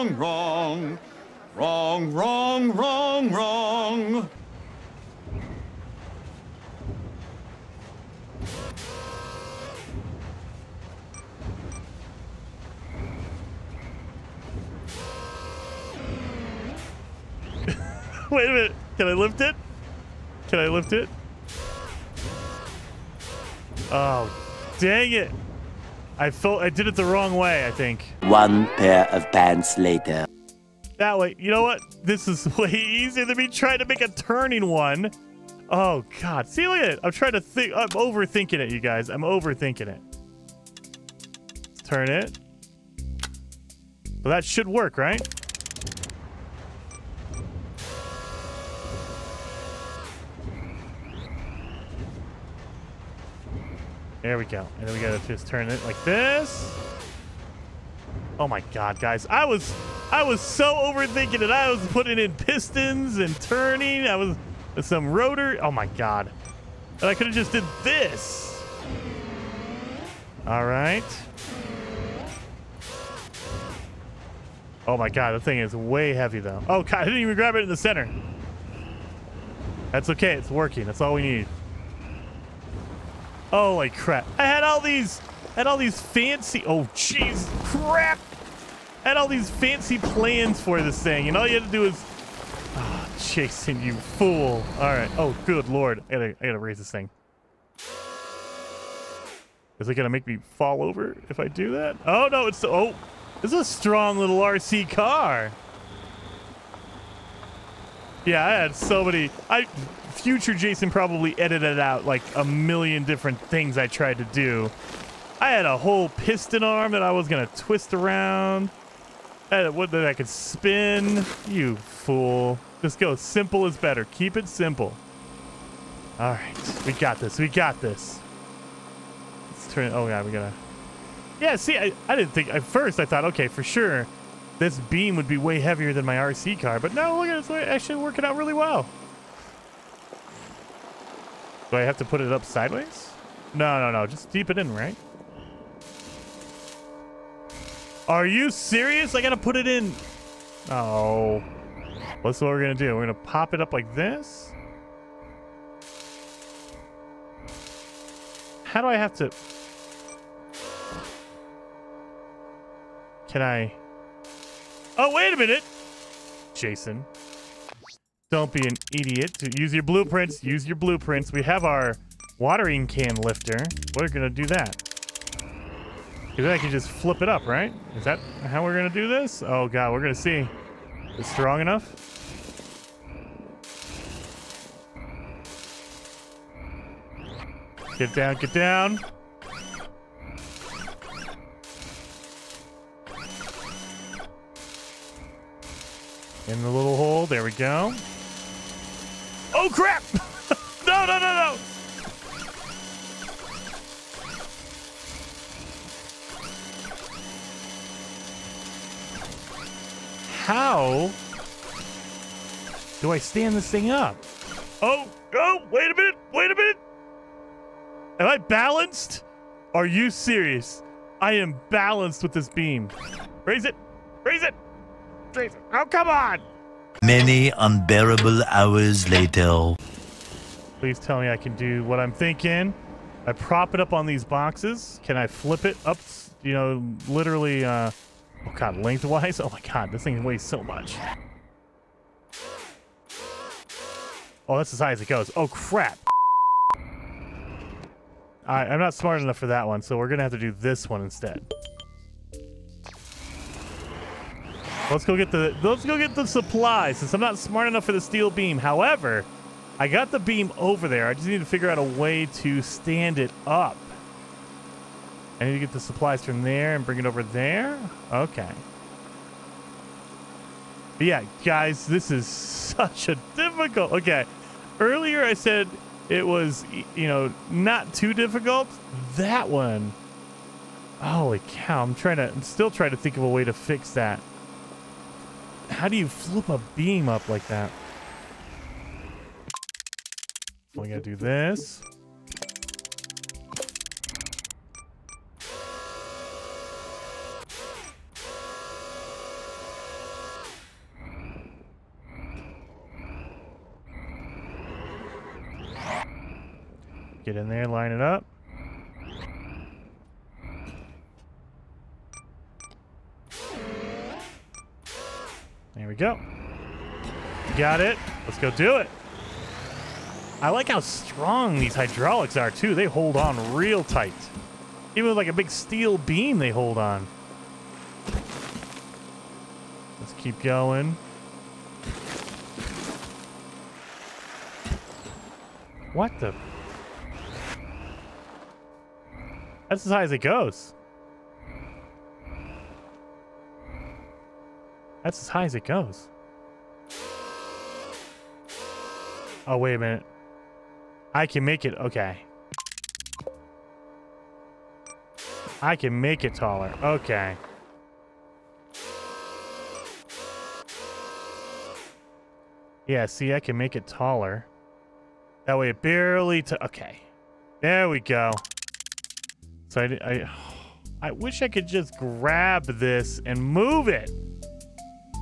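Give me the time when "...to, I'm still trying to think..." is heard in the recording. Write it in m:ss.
4:42.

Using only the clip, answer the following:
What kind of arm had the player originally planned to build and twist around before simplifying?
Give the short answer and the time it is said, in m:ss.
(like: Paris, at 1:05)
piston arm, at 1:56.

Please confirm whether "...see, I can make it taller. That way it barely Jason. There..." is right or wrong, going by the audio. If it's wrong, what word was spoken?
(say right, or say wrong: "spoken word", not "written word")
wrong: "Okay", not "Jason".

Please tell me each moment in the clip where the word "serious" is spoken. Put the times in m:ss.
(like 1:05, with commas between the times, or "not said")
2:28, 3:40.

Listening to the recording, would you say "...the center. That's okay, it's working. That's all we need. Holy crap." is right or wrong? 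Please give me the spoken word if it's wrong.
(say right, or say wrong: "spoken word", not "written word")
right.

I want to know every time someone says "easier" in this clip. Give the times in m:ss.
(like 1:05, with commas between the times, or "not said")
0:32.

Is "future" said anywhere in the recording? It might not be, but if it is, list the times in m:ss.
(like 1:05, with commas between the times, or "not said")
1:50.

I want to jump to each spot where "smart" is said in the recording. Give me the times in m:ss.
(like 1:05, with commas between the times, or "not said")
4:08, 4:17.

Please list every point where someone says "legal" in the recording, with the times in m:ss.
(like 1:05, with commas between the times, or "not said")
not said.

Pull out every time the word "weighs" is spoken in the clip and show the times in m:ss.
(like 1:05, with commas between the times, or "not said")
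4:00.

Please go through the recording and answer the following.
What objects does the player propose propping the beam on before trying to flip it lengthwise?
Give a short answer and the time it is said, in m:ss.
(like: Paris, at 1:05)
boxes, at 3:54.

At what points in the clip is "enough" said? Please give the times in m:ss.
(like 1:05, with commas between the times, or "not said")
3:01, 4:09, 4:17.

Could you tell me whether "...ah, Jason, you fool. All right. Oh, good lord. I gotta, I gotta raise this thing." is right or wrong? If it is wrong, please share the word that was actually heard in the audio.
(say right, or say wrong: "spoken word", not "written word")
right.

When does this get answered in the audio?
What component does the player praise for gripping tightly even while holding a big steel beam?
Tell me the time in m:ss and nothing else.
5:21.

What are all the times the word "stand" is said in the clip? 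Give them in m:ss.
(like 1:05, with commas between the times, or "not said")
3:33, 4:22.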